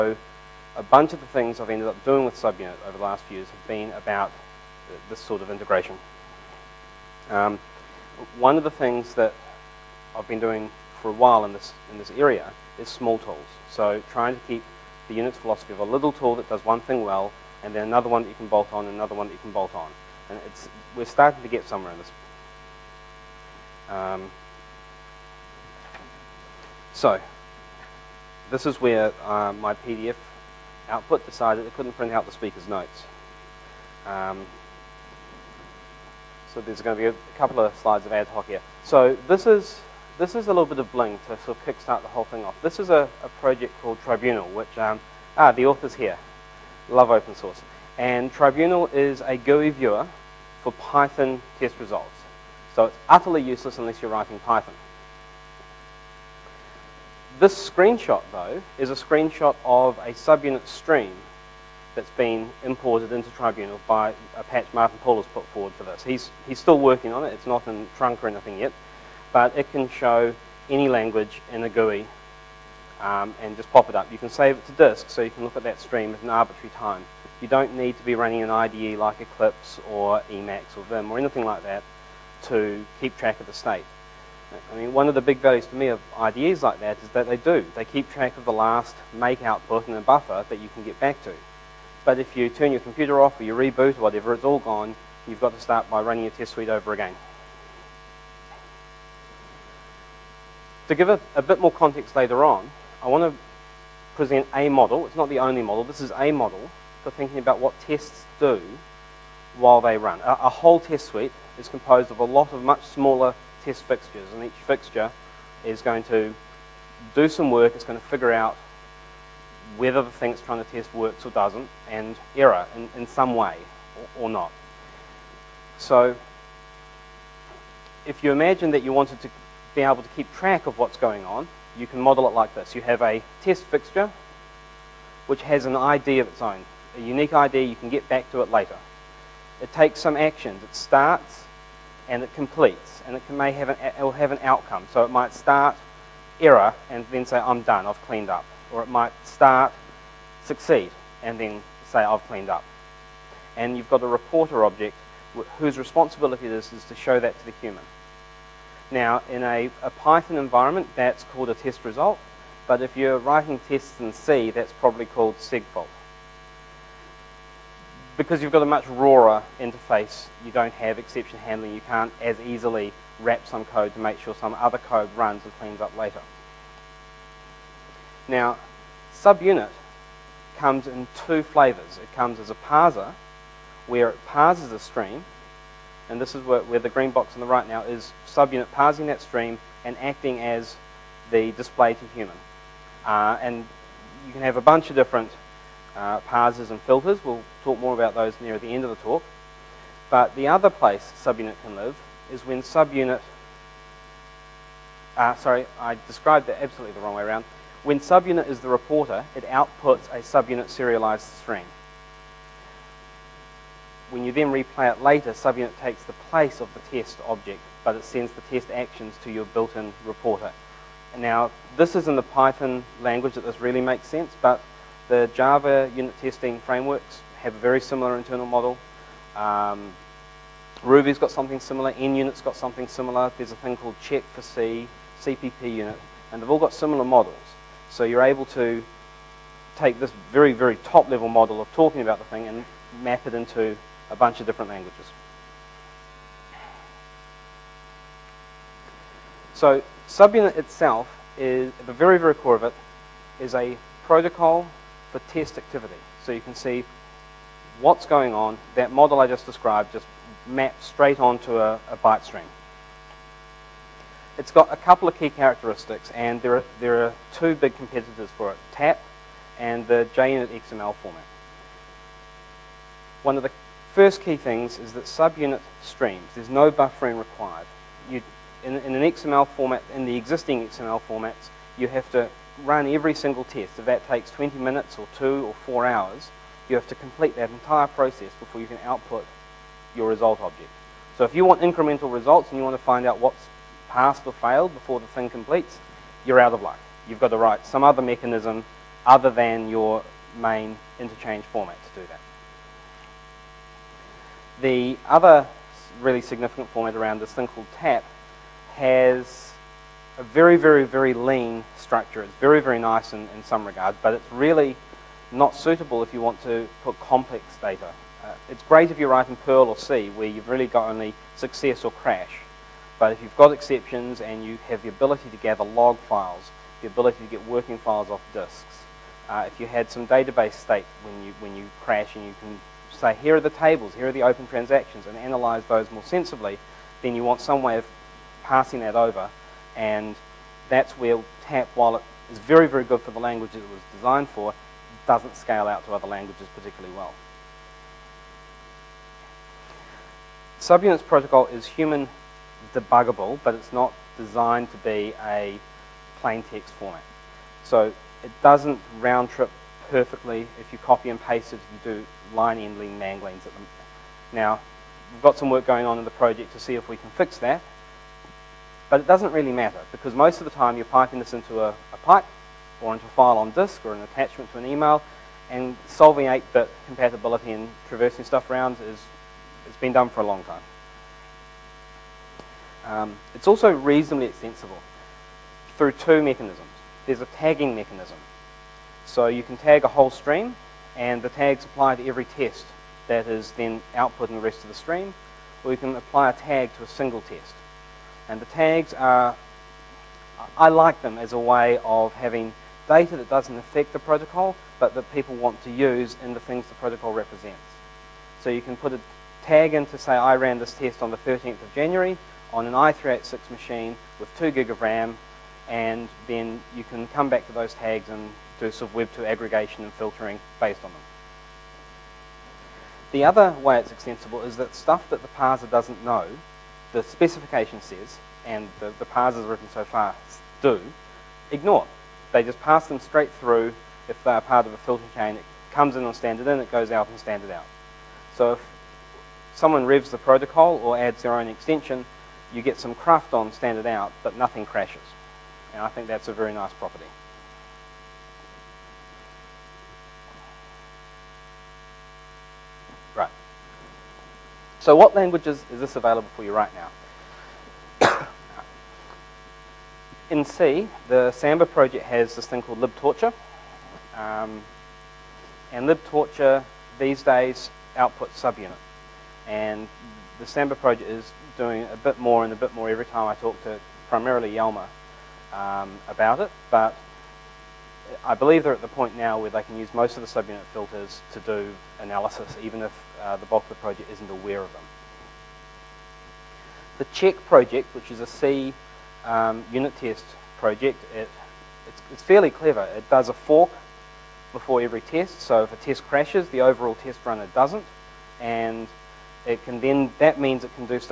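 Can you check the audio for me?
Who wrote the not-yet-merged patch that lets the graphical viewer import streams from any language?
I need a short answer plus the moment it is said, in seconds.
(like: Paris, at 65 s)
Martin Pool, at 64 s.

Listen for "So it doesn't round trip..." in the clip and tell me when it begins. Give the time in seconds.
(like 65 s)
357 s.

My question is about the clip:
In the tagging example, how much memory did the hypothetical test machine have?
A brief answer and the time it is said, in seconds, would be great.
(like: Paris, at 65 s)
2 gig, at 414 s.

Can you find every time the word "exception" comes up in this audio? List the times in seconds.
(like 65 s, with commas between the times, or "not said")
170 s, 323 s.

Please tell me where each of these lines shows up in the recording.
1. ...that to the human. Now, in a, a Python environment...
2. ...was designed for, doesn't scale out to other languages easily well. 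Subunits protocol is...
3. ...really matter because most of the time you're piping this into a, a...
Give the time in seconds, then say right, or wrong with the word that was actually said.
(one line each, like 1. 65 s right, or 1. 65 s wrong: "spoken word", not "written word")
1. 157 s right
2. 343 s wrong: "particularly", not "easily"
3. 369 s right.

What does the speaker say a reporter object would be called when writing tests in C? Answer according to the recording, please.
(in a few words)
segfault.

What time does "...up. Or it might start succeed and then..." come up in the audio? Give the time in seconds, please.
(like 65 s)
148 s.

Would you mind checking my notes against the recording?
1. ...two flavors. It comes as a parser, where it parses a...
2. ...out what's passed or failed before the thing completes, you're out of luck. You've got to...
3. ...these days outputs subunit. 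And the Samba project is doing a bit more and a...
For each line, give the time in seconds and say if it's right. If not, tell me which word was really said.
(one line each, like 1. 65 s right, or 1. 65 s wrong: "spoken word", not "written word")
1. 181 s right
2. 293 s right
3. 466 s right.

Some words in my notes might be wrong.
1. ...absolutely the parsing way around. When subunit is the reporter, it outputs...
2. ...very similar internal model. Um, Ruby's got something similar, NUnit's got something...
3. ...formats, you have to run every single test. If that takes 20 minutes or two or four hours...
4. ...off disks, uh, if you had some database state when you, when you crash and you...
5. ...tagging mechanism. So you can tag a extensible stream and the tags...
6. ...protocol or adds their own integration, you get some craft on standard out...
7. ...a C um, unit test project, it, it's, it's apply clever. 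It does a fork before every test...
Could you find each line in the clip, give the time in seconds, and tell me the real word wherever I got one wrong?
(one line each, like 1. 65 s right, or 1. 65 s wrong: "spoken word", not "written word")
1. 206 s wrong: "wrong", not "parsing"
2. 227 s right
3. 281 s right
4. 328 s right
5. 387 s wrong: "whole", not "extensible"
6. 440 s wrong: "extension", not "integration"
7. 488 s wrong: "fairly", not "apply".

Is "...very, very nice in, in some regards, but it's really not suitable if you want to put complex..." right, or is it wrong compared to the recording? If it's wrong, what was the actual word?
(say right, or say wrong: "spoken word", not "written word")
right.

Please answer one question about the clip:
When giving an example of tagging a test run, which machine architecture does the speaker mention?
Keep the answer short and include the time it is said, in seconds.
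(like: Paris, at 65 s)
i386, at 412 s.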